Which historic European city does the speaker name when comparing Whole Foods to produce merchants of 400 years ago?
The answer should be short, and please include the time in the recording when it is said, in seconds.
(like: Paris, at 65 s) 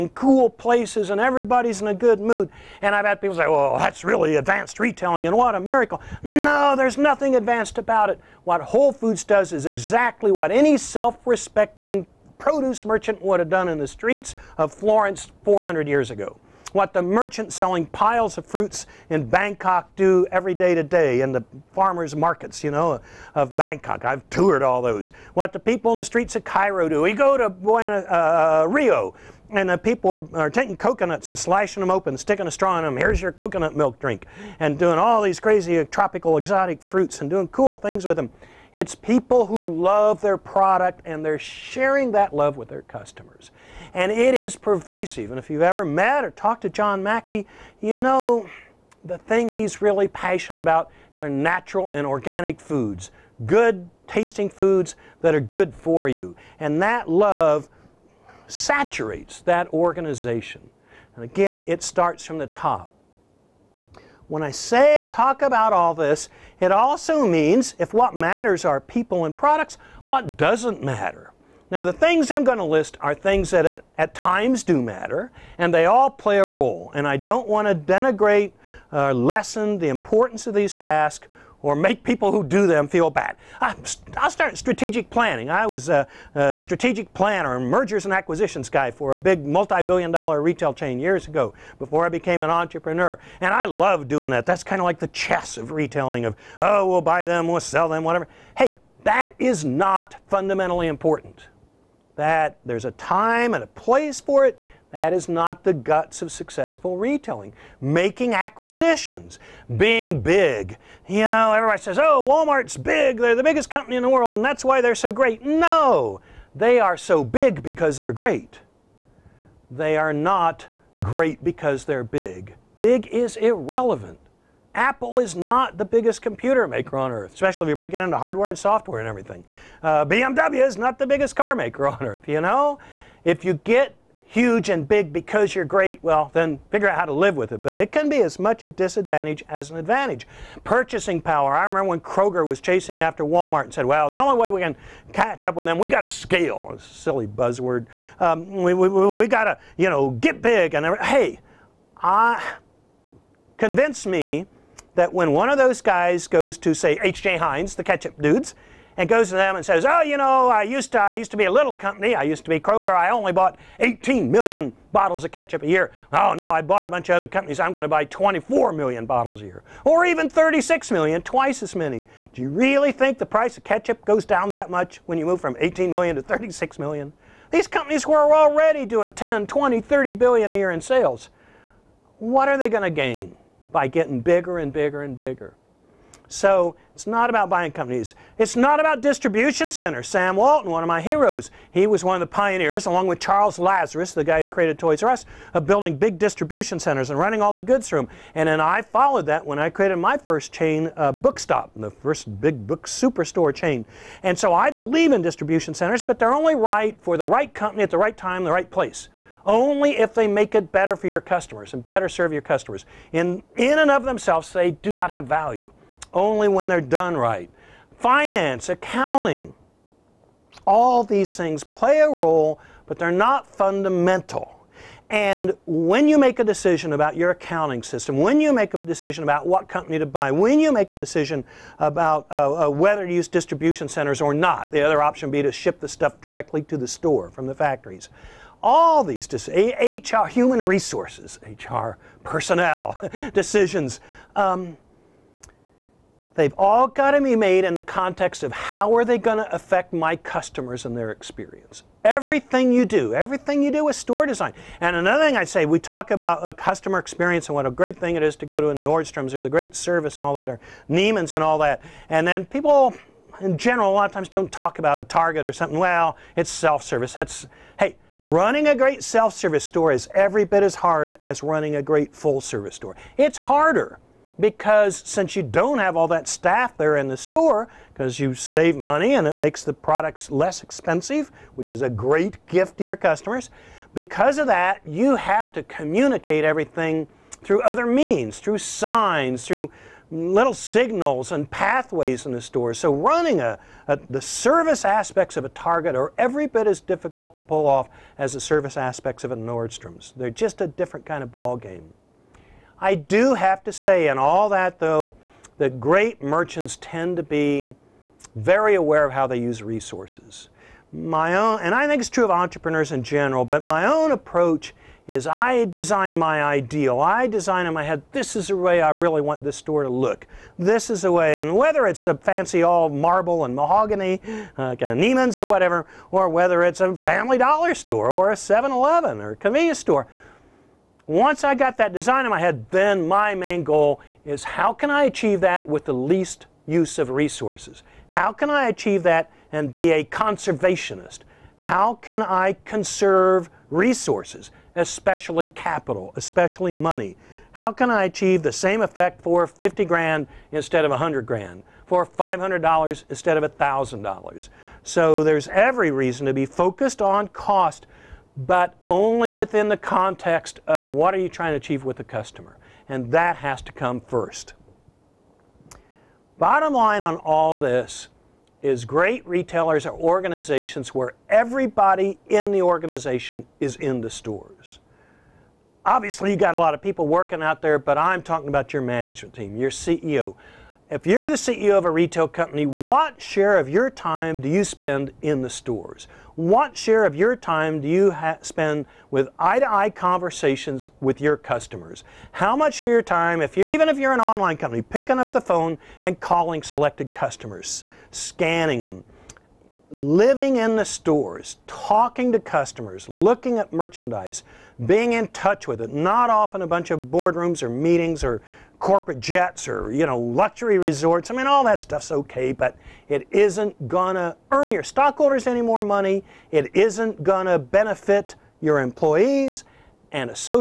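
Florence, at 14 s.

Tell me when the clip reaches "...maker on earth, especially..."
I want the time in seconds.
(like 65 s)
126 s.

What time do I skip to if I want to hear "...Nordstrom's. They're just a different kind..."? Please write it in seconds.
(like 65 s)
299 s.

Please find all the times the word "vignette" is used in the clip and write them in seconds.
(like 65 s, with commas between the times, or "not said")
not said.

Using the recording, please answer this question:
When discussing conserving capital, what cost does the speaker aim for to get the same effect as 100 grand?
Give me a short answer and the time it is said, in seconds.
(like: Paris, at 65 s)
50 grand, at 349 s.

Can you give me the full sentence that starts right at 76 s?
And I don't want to denigrate or uh, lessen the importance of these tasks or make people who do them feel bad.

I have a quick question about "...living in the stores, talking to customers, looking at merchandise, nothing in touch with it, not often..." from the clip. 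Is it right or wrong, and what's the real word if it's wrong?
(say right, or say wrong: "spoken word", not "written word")
wrong: "being", not "nothing".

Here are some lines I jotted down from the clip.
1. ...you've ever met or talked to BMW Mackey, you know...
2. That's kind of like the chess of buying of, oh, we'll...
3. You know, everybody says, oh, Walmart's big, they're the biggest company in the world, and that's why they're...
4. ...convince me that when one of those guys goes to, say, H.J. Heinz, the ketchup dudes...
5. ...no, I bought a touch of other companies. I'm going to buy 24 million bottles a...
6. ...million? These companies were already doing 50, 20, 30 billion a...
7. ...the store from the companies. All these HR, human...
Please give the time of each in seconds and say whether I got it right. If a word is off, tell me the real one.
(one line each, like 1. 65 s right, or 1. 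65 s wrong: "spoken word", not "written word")
1. 45 s wrong: "John", not "BMW"
2. 94 s wrong: "retailing", not "buying"
3. 111 s right
4. 153 s right
5. 166 s wrong: "bunch", not "touch"
6. 176 s wrong: "10", not "50"
7. 236 s wrong: "factories", not "companies".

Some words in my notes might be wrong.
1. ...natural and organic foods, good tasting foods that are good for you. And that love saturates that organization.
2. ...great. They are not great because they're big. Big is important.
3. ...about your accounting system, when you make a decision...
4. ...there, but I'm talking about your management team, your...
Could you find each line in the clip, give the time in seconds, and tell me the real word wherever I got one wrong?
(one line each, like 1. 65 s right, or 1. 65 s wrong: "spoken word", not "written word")
1. 51 s right
2. 118 s wrong: "irrelevant", not "important"
3. 226 s right
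4. 377 s right.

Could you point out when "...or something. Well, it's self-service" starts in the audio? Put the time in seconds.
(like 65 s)
265 s.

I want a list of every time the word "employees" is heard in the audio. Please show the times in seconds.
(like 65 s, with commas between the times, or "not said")
418 s.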